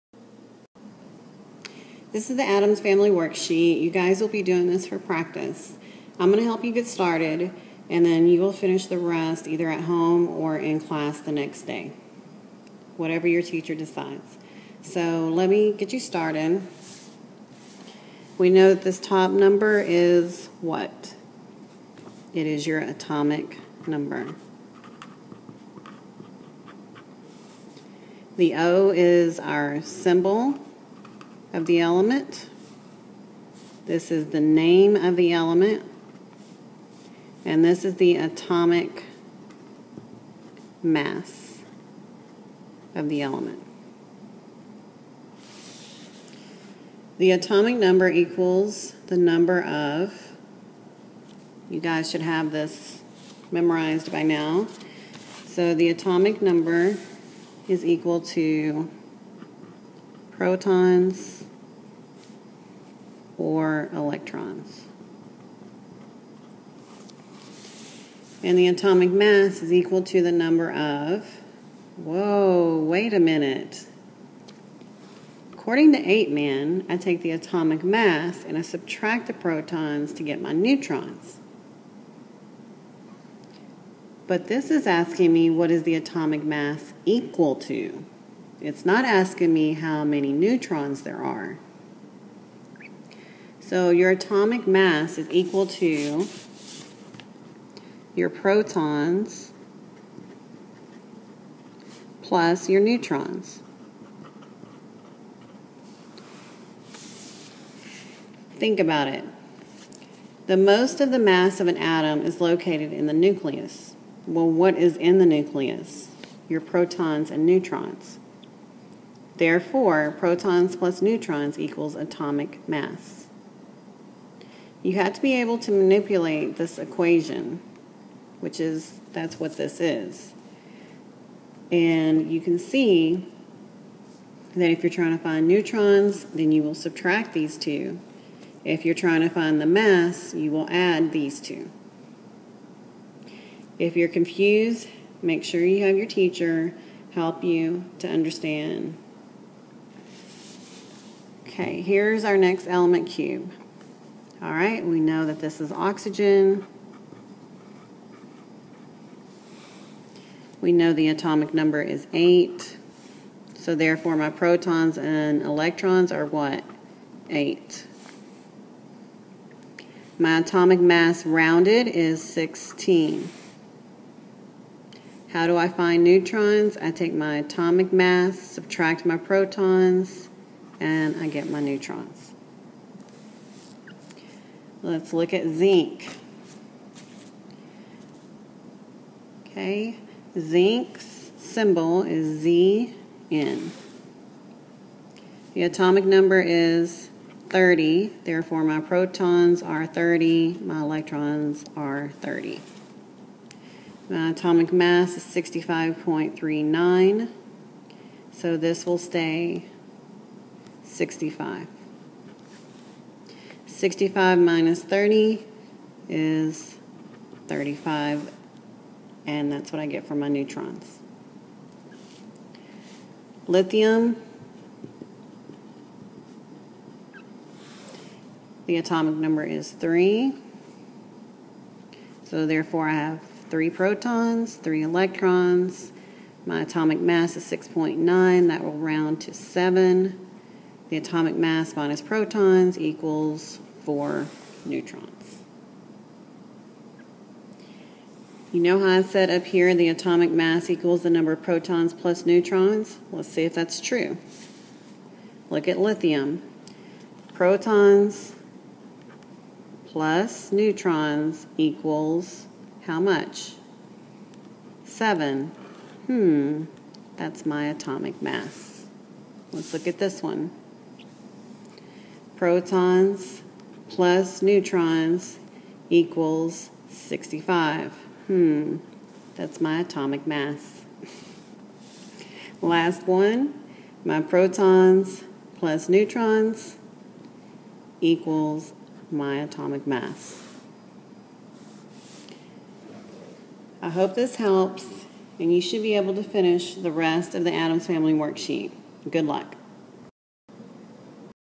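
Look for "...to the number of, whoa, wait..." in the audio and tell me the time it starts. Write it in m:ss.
1:10.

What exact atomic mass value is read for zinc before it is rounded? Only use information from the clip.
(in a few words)
65.39.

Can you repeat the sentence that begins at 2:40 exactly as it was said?
We know the atomic number is 8.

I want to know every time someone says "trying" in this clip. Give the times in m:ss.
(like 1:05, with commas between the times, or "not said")
2:14, 2:18.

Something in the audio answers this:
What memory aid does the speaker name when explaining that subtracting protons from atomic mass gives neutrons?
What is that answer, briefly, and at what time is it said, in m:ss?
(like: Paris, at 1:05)
APE MAN, at 1:15.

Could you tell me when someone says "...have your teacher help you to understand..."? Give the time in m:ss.
2:25.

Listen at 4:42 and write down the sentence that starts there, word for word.
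Last one, my protons plus neutrons equals my atomic mass.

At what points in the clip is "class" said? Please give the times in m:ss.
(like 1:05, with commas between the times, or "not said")
0:10.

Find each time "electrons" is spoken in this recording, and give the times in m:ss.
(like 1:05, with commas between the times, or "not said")
1:03, 2:45, 3:20, 3:54.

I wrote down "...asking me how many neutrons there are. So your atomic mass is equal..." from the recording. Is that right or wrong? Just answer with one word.
right.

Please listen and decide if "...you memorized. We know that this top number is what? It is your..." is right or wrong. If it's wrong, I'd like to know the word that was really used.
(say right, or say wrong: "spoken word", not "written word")
wrong: "started", not "memorized".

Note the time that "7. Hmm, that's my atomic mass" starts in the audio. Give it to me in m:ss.
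4:24.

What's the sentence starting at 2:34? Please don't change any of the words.
All right, we know that this is oxygen.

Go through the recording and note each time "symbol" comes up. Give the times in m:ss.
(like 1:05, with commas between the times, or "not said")
0:29, 3:11.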